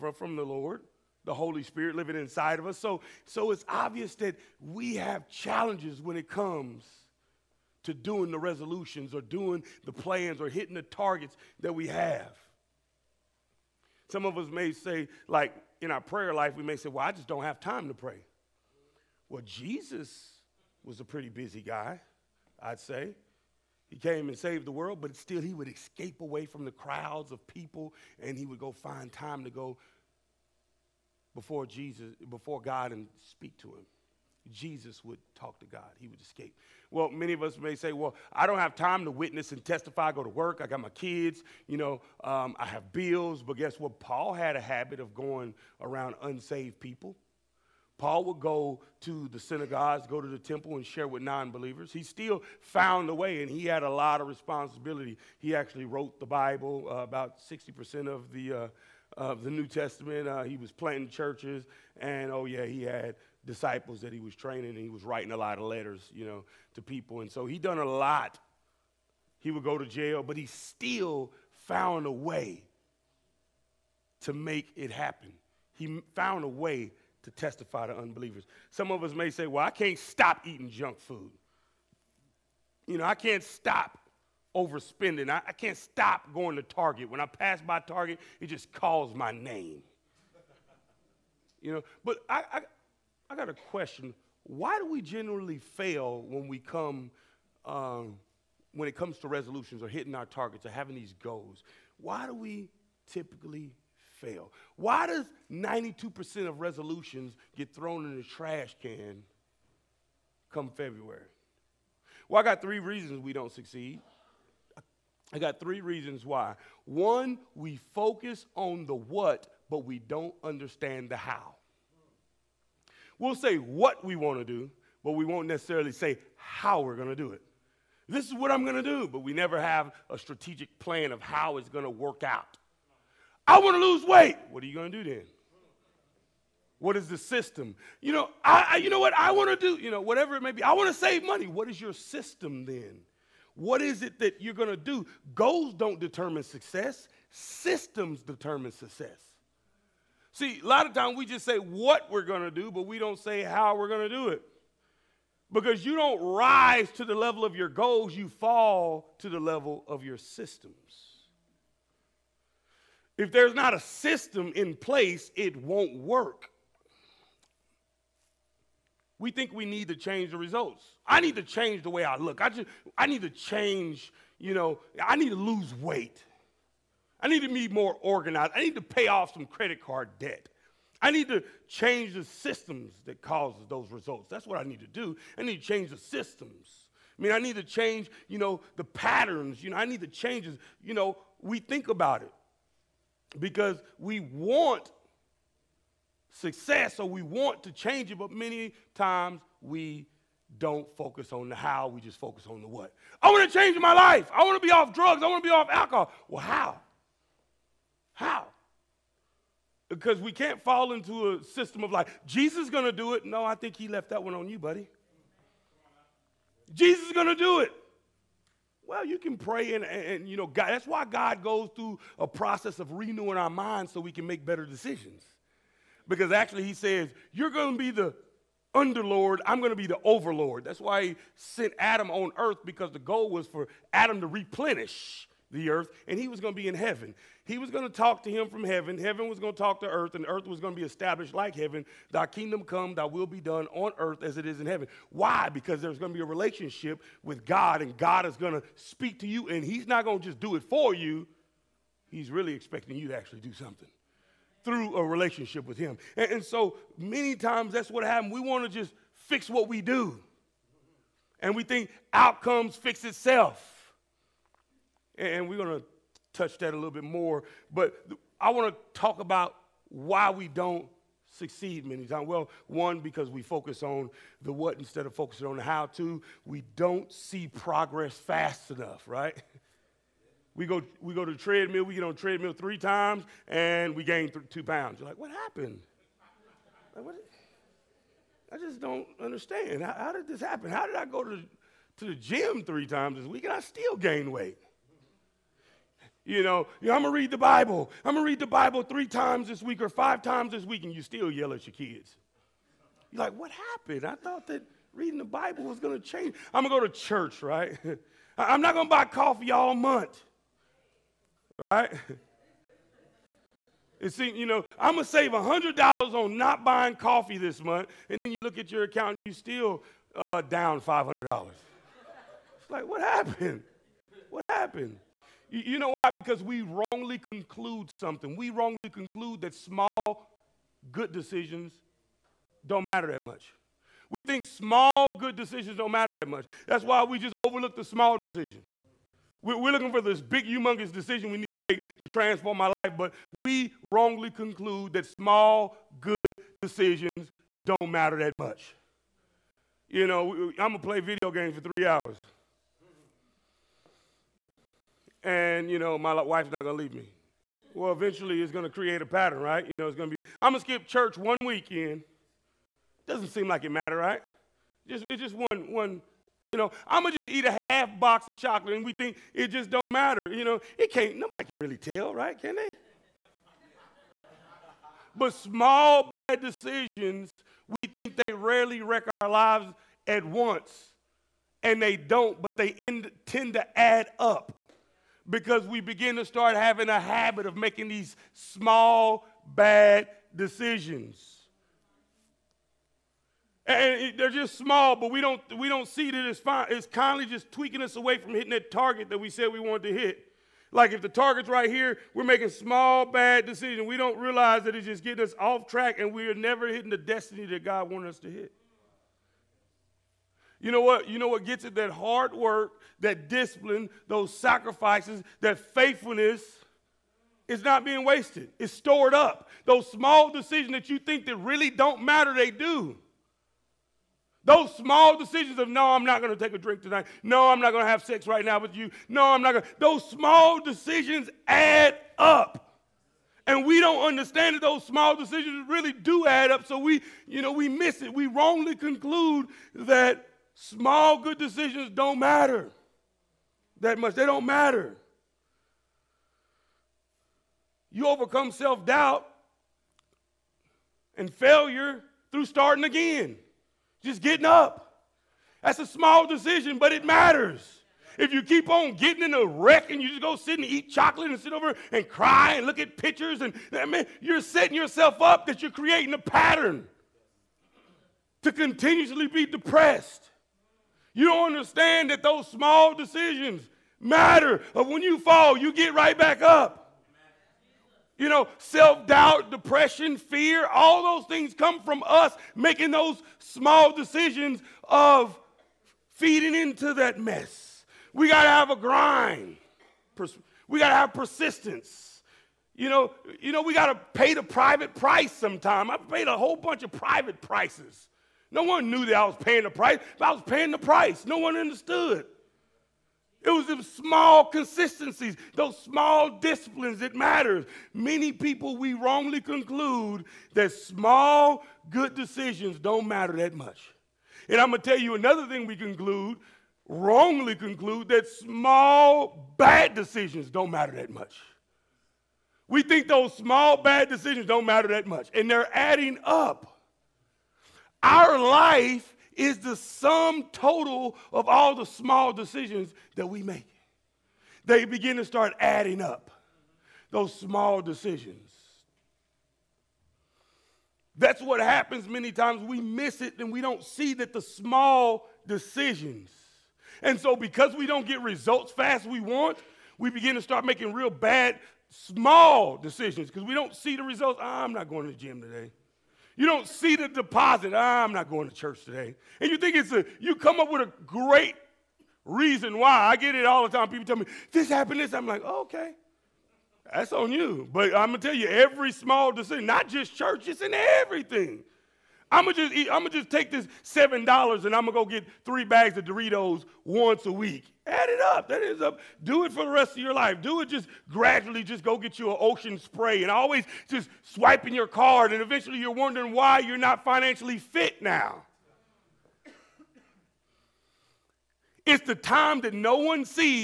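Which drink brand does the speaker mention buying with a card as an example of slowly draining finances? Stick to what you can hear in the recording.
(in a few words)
Ocean Spray.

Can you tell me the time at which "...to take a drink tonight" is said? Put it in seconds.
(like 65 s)
426 s.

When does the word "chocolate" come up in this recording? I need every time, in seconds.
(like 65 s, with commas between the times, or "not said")
368 s, 460 s.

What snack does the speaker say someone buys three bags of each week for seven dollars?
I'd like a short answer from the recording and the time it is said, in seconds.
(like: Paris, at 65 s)
Doritos, at 576 s.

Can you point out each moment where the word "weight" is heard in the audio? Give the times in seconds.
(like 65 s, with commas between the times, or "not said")
134 s, 175 s, 294 s.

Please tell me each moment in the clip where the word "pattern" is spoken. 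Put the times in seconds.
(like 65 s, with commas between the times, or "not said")
188 s, 359 s, 466 s.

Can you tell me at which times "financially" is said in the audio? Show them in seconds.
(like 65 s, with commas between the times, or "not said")
587 s.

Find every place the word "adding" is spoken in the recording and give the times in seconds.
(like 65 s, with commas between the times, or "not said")
525 s, 535 s.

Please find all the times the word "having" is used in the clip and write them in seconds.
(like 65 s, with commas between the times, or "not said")
100 s, 386 s.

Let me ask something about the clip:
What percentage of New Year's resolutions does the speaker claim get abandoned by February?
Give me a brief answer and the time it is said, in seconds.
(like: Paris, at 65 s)
92%, at 105 s.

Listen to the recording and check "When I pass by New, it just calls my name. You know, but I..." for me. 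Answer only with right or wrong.
wrong.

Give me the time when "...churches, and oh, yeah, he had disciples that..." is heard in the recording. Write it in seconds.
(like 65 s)
61 s.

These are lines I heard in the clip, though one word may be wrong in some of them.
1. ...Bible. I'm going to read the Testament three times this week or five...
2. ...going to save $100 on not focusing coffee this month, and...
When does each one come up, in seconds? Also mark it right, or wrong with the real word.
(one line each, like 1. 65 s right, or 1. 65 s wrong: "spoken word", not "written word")
1. 297 s wrong: "Bible", not "Testament"
2. 314 s wrong: "buying", not "focusing".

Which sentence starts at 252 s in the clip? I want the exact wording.
He's really expecting you to actually do something through a relationship with him.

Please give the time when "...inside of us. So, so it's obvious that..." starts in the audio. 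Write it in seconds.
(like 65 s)
2 s.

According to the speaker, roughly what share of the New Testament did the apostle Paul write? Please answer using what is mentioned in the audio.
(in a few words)
60%.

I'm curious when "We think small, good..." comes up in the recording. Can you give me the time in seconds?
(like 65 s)
334 s.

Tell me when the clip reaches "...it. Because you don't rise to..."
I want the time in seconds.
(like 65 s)
154 s.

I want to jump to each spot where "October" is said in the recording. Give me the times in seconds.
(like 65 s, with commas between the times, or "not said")
not said.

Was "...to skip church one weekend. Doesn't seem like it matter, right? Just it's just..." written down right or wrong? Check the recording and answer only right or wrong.
right.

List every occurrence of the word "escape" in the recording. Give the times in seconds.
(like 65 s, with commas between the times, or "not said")
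25 s, 36 s.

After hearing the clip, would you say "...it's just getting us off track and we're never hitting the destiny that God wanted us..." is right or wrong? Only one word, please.
right.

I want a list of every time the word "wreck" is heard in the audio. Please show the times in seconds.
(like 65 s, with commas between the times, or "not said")
378 s, 459 s.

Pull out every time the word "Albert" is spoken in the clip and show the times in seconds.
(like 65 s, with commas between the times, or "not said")
not said.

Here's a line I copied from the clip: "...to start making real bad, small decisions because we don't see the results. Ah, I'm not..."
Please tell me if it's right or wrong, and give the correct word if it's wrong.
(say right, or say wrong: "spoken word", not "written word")
right.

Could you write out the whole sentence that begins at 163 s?
If there's not a system in place, it won't work.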